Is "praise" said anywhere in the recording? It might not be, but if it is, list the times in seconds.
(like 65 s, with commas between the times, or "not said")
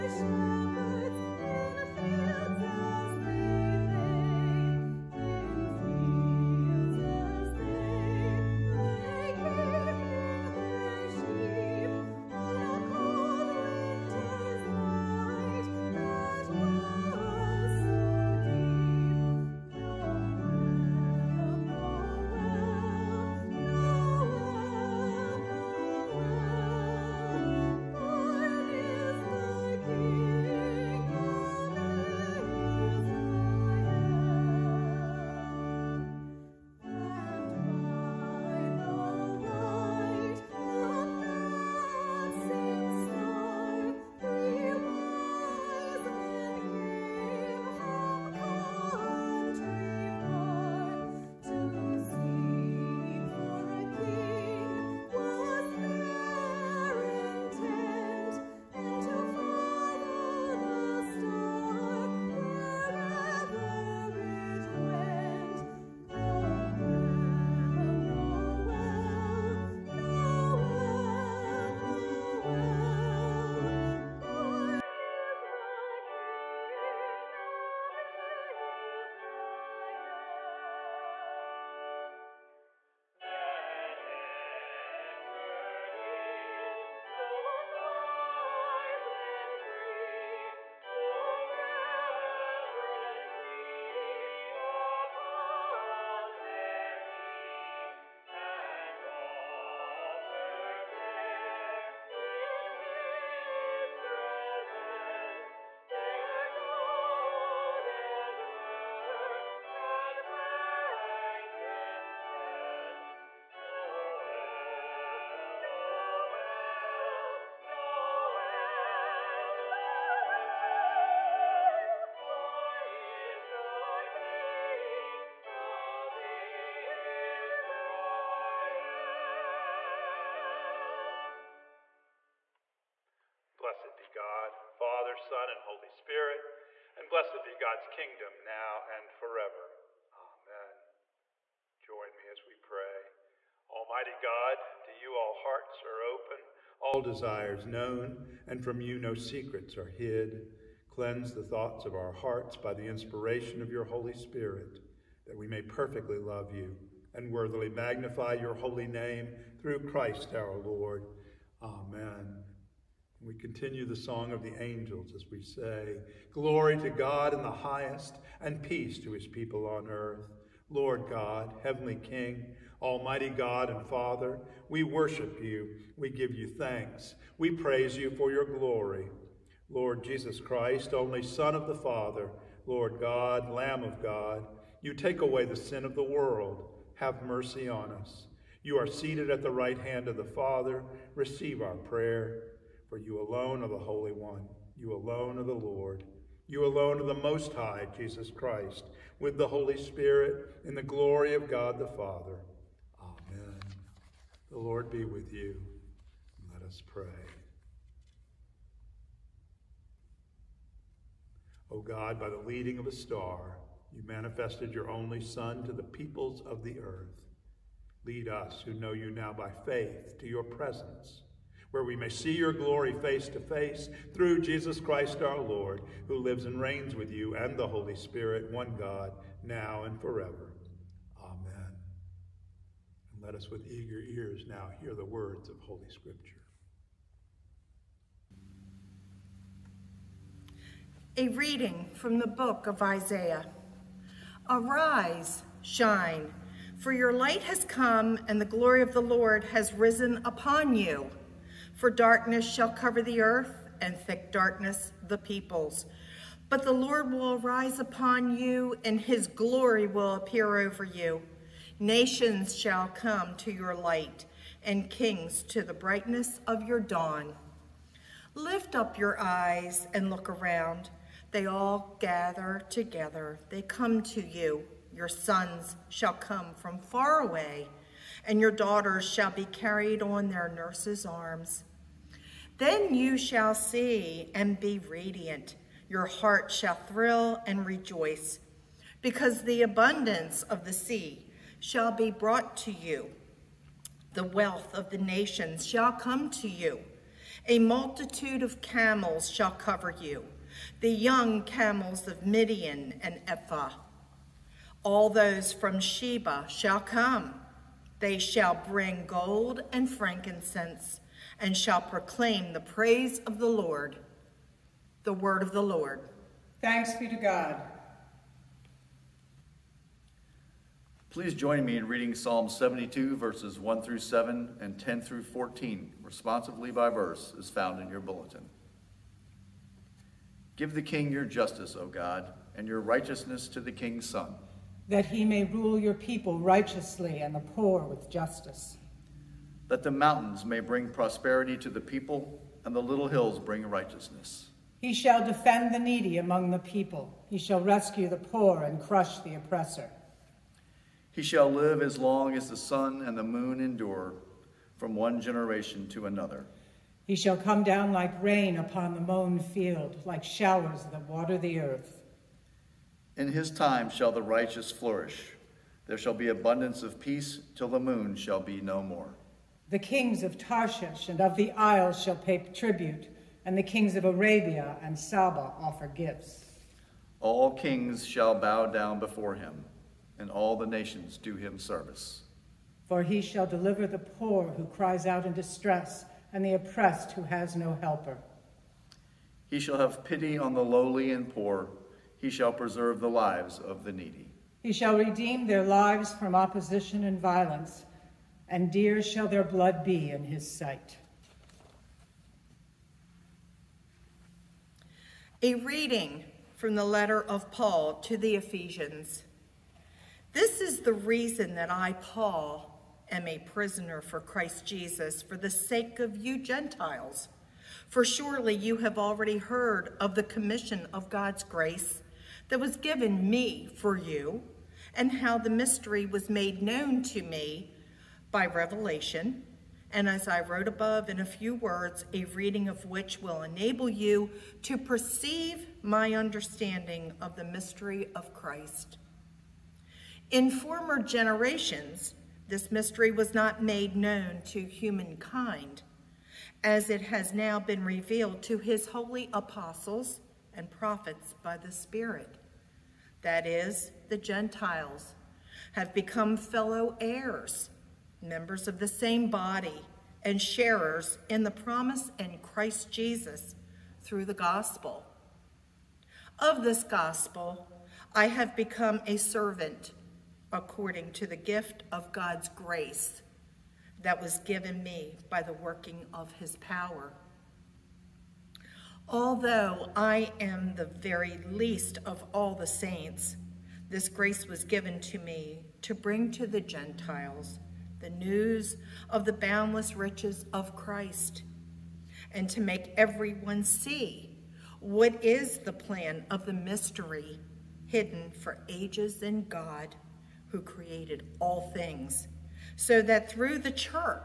177 s, 312 s.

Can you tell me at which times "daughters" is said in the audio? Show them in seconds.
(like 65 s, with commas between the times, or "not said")
278 s.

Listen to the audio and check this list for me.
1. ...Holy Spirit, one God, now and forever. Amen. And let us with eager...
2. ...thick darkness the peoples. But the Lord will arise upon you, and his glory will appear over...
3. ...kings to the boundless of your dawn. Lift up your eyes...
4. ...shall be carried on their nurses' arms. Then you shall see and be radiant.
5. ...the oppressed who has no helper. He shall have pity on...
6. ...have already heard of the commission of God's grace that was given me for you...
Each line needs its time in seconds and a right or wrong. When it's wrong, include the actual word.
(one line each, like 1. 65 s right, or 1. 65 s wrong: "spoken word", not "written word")
1. 227 s right
2. 253 s right
3. 264 s wrong: "brightness", not "boundless"
4. 279 s right
5. 386 s right
6. 418 s right.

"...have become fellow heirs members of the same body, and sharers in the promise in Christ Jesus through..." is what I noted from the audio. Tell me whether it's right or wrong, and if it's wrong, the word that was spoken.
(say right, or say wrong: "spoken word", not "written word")
right.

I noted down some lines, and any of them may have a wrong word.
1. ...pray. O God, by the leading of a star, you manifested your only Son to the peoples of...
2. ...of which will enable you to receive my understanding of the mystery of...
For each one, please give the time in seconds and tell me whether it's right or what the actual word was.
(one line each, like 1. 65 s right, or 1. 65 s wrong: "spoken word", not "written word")
1. 206 s right
2. 432 s wrong: "perceive", not "receive".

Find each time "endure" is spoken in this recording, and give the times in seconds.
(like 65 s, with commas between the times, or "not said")
353 s.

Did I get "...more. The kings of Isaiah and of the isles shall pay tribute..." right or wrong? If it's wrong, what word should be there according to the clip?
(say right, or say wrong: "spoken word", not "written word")
wrong: "Tarshish", not "Isaiah".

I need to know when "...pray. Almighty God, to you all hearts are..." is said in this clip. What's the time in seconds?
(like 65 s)
142 s.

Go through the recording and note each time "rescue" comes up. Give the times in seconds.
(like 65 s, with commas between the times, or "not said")
347 s.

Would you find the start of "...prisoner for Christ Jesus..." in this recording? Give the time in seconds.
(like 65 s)
413 s.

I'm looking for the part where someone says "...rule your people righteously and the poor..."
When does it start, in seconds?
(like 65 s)
335 s.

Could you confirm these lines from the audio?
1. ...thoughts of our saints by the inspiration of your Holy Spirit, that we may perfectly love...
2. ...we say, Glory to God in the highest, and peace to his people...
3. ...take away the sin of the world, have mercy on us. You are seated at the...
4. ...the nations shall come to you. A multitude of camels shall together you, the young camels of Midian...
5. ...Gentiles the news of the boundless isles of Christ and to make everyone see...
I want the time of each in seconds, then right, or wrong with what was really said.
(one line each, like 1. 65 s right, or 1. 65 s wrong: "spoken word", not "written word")
1. 151 s wrong: "hearts", not "saints"
2. 165 s right
3. 184 s right
4. 294 s wrong: "cover", not "together"
5. 486 s wrong: "riches", not "isles".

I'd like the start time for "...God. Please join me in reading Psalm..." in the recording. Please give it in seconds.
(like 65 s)
317 s.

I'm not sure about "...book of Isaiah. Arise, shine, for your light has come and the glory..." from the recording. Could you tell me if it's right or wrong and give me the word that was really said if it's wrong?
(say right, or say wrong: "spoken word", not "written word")
right.